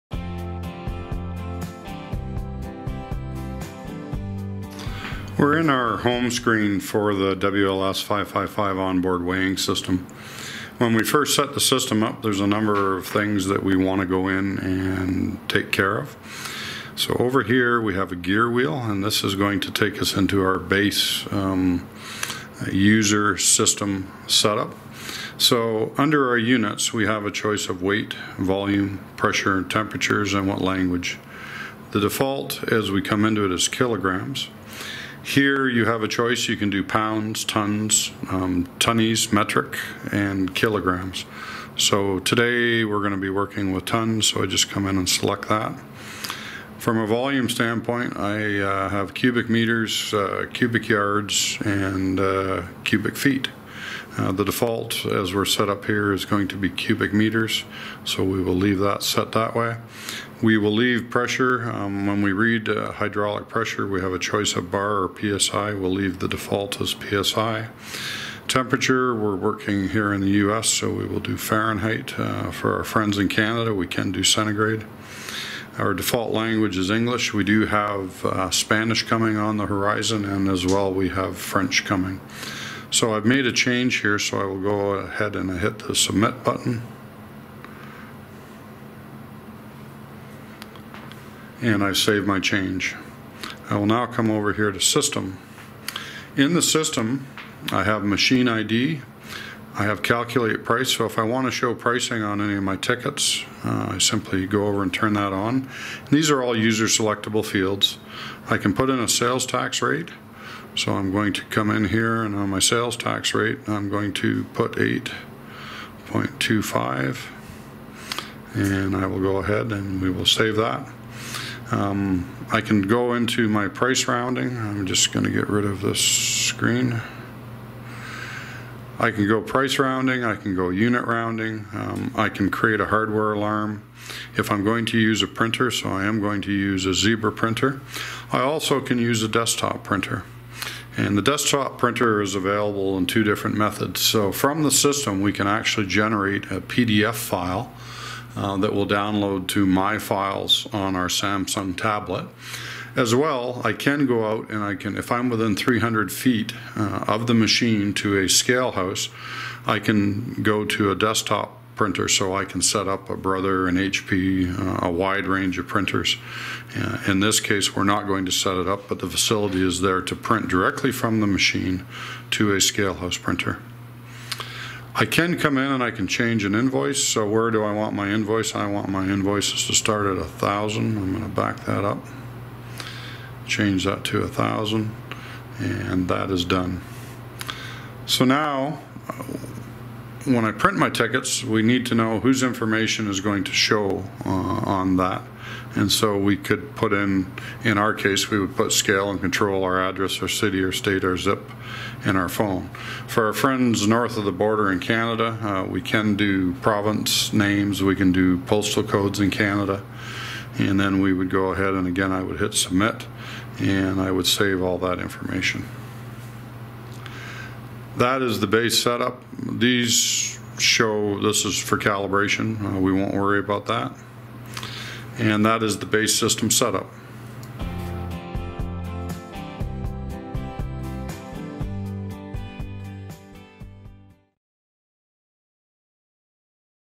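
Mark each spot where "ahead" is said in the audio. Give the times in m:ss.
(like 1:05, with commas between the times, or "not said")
1:24, 1:59, 3:31.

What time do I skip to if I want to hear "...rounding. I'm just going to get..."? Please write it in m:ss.
2:04.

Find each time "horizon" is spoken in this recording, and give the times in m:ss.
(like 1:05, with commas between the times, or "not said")
1:19.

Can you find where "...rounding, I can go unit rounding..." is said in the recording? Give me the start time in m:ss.
2:09.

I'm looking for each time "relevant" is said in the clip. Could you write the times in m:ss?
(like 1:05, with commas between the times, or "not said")
not said.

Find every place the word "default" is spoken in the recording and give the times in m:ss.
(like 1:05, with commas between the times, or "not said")
0:31, 0:54, 1:06, 1:15.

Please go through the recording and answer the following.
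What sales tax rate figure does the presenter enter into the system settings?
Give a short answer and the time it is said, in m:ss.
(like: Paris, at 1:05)
8.25, at 1:54.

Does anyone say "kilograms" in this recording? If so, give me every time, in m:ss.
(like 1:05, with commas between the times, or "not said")
0:33, 0:40.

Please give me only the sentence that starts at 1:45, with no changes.
And these are all user selectable fields.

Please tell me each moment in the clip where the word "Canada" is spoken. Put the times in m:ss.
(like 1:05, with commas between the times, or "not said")
1:13, 3:24, 3:29.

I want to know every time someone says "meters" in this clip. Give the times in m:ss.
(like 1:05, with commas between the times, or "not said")
0:49, 0:57.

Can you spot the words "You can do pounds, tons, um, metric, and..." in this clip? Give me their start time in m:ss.
0:36.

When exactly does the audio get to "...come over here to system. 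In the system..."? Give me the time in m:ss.
1:34.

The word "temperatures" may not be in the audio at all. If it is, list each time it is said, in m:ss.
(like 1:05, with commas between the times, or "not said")
0:29, 1:08.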